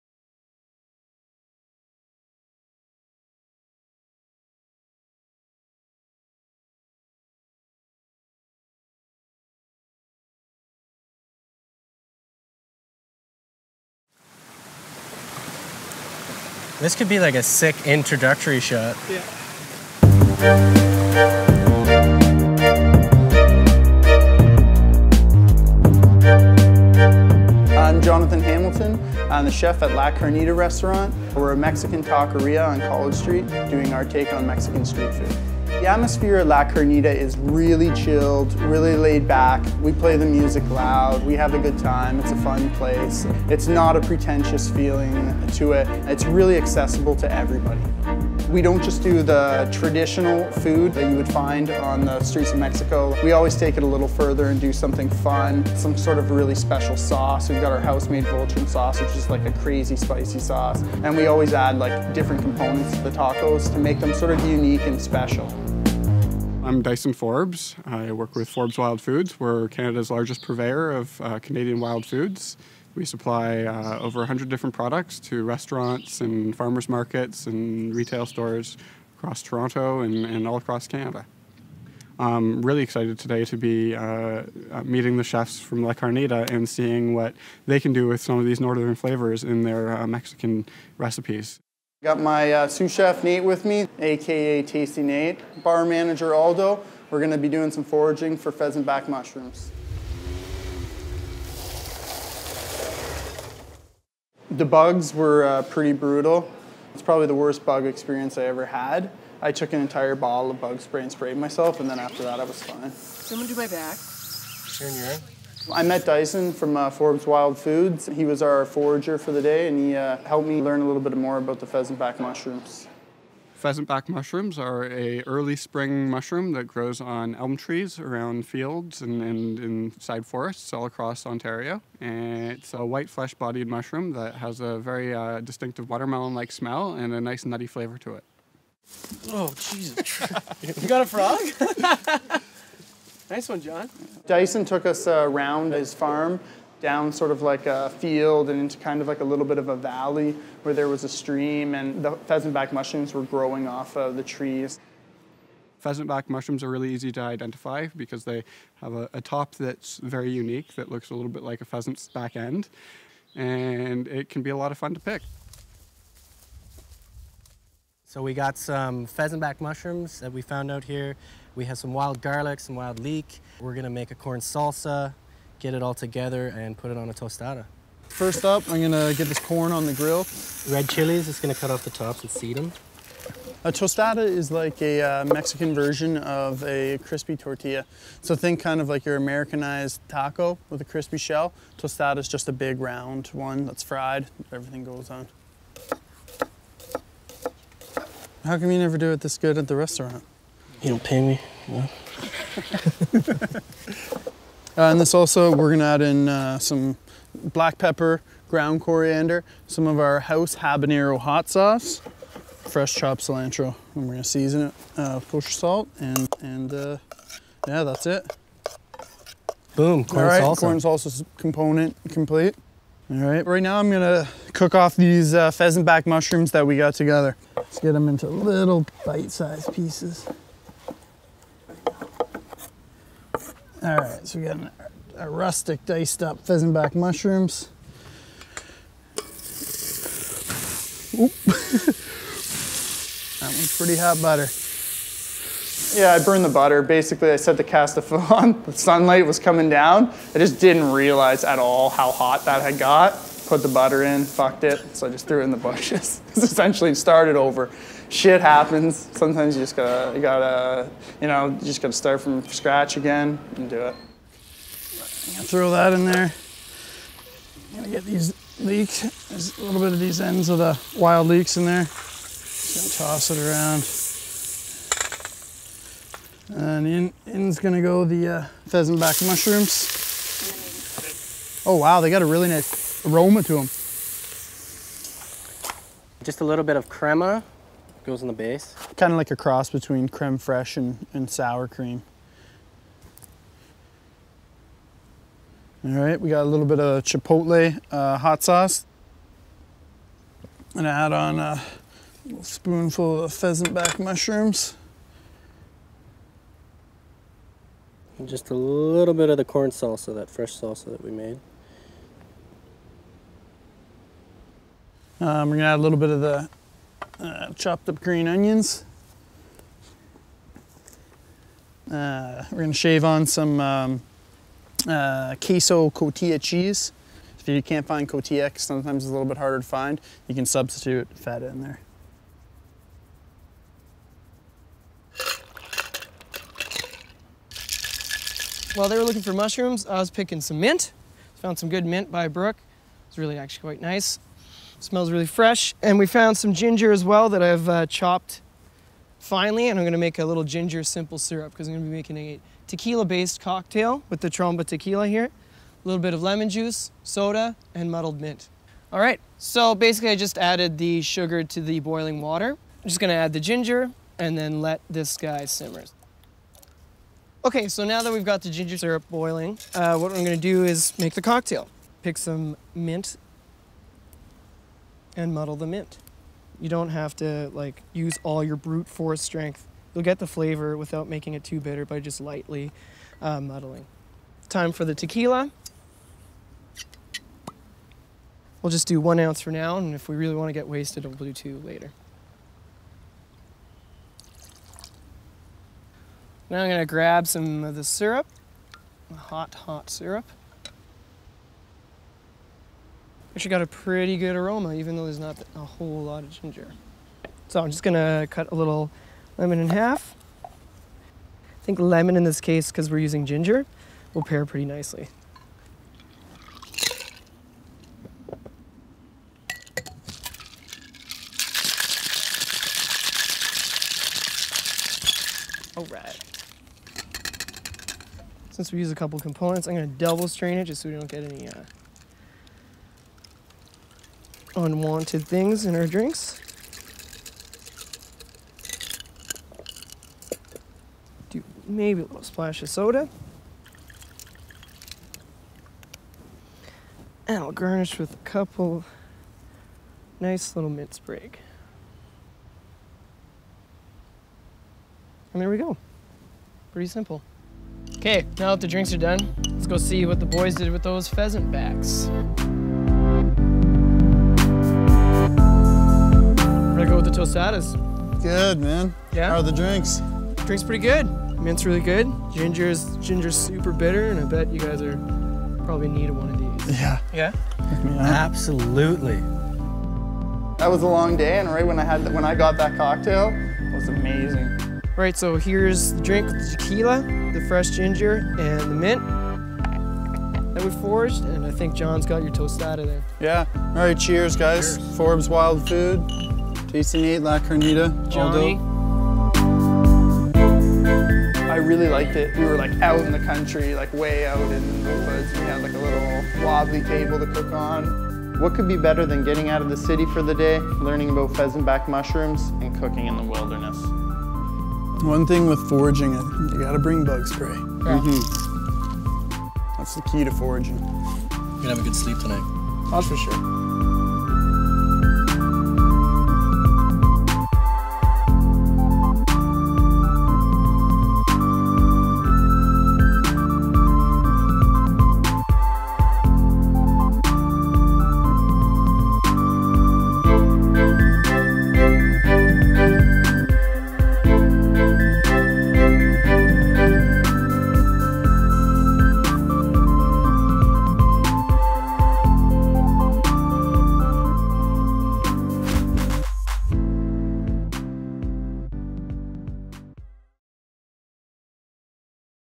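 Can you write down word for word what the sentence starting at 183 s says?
A tostada is like a uh, Mexican version of a crispy tortilla.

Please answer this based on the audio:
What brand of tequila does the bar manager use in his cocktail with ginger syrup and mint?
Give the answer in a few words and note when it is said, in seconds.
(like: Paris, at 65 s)
Tromba, at 354 s.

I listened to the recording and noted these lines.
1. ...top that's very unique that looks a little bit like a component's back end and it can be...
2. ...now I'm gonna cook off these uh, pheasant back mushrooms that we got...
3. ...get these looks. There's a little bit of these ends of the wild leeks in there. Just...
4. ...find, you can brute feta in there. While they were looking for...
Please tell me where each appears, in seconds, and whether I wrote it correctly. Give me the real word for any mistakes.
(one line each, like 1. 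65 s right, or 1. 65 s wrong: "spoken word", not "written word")
1. 159 s wrong: "pheasant", not "component"
2. 223 s right
3. 267 s wrong: "leeks", not "looks"
4. 329 s wrong: "substitute", not "brute".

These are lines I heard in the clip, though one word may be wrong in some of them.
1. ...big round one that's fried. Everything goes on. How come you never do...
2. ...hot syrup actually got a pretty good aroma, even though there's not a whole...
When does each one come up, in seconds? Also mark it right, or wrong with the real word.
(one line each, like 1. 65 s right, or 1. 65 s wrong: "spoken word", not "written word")
1. 192 s right
2. 399 s right.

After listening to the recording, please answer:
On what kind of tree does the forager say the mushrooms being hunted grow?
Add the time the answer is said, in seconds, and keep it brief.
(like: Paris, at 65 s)
elm trees, at 127 s.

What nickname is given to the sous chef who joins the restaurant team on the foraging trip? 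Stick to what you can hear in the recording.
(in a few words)
Tasty Nate.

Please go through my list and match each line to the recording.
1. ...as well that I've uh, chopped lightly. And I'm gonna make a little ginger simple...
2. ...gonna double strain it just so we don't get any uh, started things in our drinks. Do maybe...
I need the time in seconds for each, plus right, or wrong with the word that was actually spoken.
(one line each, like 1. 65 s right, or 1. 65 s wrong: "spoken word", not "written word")
1. 346 s wrong: "finely", not "lightly"
2. 429 s wrong: "unwanted", not "started".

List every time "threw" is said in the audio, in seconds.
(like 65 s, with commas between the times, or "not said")
255 s.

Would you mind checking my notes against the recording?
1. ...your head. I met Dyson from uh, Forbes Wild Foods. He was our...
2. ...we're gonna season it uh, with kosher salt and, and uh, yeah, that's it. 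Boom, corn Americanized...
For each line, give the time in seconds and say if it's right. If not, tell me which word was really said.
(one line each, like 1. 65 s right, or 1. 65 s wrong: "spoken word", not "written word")
1. 114 s right
2. 214 s wrong: "All", not "Americanized".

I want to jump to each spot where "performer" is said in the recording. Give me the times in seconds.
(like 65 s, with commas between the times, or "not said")
not said.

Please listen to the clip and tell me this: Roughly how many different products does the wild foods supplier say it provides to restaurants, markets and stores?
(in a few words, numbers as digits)
over 100.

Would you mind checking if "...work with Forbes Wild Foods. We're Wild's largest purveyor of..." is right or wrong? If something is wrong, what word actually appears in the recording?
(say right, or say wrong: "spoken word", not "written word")
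wrong: "Canada", not "Wild".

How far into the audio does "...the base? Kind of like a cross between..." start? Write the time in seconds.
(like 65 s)
288 s.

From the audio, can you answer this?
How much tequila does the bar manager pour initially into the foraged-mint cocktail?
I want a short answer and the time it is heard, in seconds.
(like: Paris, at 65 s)
1 ounce, at 389 s.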